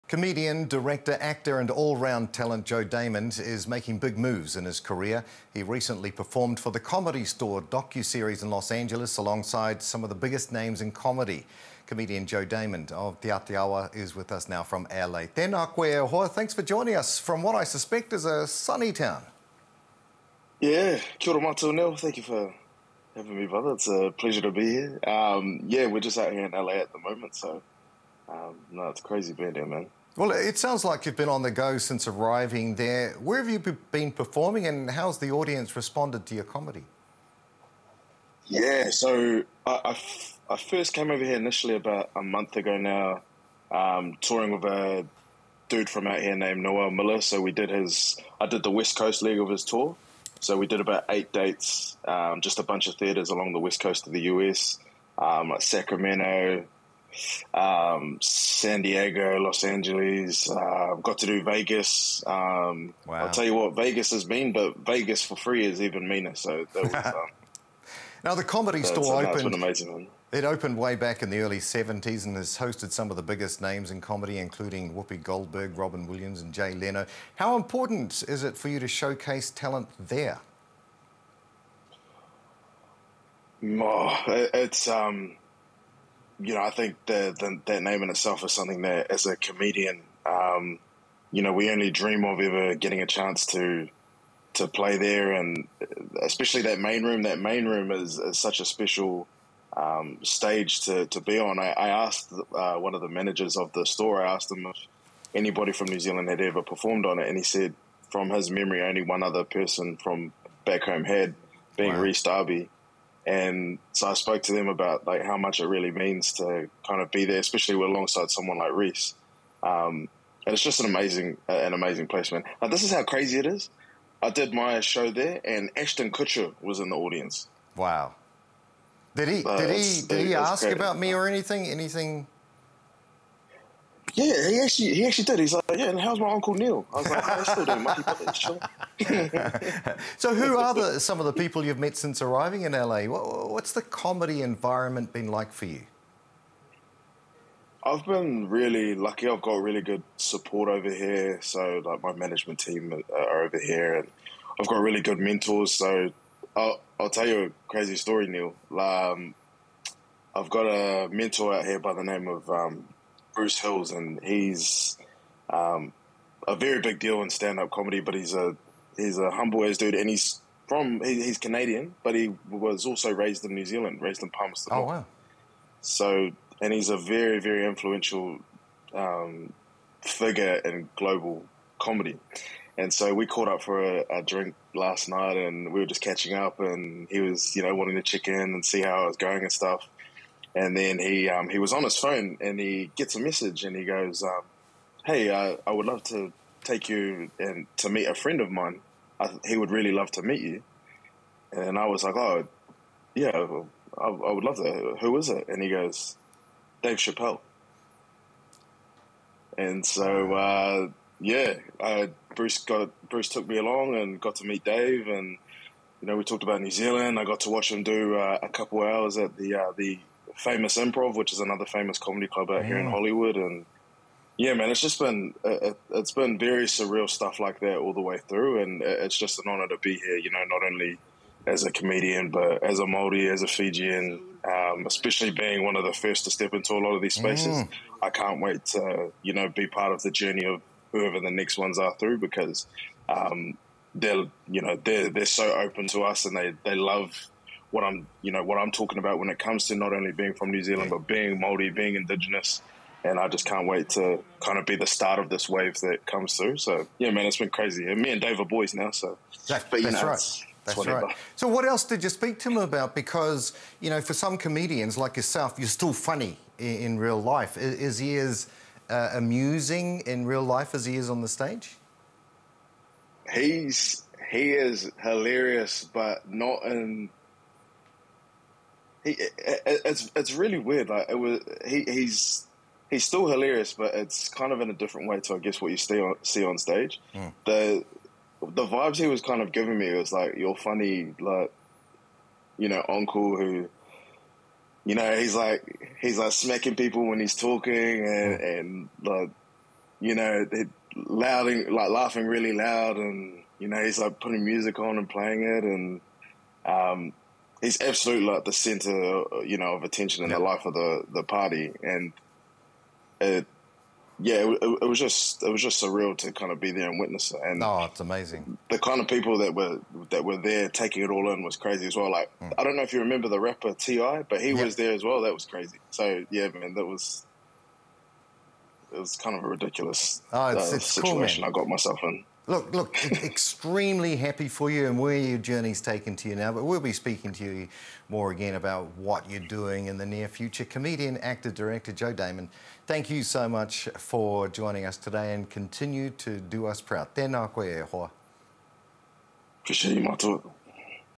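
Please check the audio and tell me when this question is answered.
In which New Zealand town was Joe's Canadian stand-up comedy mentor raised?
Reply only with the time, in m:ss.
2:54.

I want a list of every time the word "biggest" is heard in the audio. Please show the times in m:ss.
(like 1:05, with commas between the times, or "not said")
0:10, 1:13.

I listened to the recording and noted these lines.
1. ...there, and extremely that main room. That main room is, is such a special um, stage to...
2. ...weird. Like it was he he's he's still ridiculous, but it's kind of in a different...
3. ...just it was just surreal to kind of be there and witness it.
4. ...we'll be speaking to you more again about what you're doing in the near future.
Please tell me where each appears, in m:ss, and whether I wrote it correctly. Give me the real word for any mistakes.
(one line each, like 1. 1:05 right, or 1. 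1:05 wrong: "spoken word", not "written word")
1. 1:34 wrong: "especially", not "extremely"
2. 4:40 wrong: "hilarious", not "ridiculous"
3. 5:14 right
4. 5:36 right.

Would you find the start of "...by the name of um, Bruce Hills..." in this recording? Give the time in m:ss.
2:41.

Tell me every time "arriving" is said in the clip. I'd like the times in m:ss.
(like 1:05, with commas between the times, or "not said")
0:32, 2:22.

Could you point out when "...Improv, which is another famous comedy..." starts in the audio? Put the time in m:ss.
3:40.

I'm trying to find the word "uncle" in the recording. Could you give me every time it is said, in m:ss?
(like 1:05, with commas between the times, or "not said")
2:16, 4:52.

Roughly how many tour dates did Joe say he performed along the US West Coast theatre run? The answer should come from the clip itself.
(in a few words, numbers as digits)
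8.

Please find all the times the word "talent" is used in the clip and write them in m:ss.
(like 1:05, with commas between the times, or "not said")
0:02, 1:19.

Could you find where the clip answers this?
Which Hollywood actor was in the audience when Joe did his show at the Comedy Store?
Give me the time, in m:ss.
2:05.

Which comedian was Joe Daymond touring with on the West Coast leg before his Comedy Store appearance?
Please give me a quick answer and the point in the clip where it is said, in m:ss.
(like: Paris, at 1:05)
Noel Miller, at 0:46.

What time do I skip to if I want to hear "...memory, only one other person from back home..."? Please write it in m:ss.
1:48.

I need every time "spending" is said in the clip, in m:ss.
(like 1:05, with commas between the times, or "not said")
not said.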